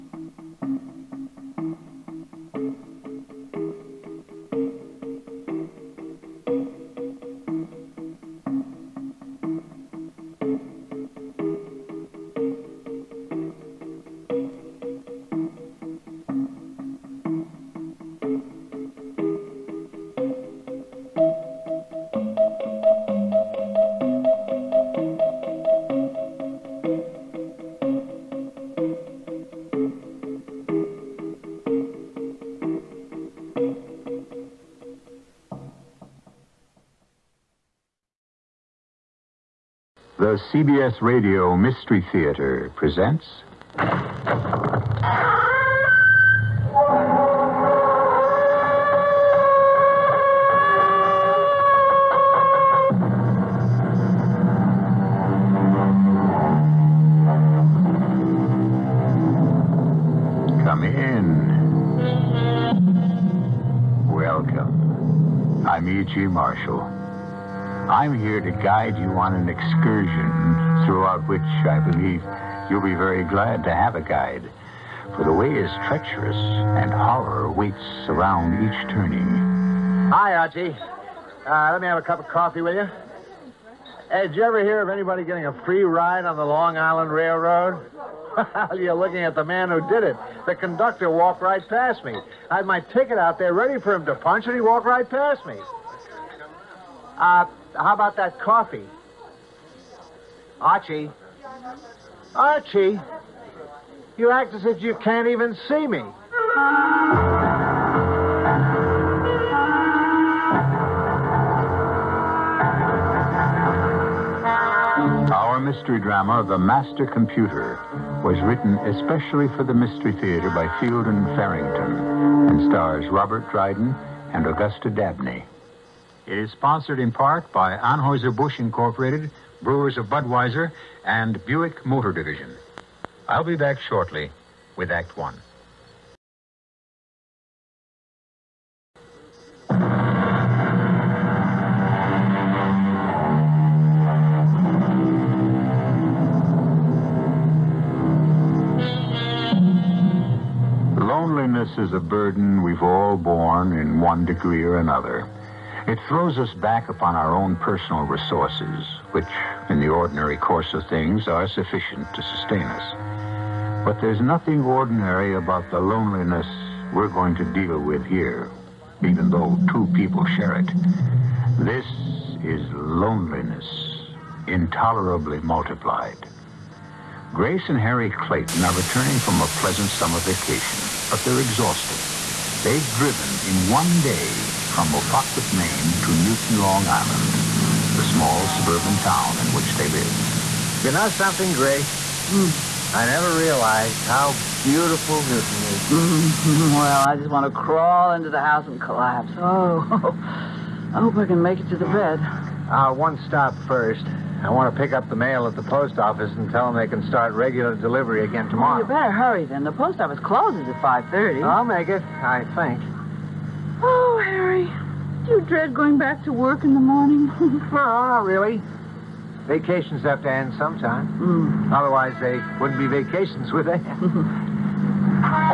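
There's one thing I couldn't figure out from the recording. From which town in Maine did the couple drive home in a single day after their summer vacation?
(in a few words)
Mopaquit.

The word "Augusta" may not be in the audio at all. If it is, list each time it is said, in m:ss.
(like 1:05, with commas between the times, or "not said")
2:04.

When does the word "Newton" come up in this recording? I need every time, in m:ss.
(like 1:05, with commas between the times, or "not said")
3:06, 3:15.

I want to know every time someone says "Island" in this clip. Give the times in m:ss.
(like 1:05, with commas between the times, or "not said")
1:26, 3:06.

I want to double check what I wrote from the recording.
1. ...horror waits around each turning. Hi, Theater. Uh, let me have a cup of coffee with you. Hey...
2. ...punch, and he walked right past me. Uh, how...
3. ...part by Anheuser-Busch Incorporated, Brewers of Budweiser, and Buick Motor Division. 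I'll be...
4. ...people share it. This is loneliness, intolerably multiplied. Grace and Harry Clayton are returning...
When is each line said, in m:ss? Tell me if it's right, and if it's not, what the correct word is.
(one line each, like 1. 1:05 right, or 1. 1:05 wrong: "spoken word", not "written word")
1. 1:16 wrong: "Archie", not "Theater"
2. 1:34 right
3. 2:07 right
4. 2:49 right.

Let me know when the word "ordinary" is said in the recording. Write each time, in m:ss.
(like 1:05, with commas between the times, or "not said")
2:39, 2:44.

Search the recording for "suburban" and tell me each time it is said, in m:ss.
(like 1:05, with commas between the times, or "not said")
3:08.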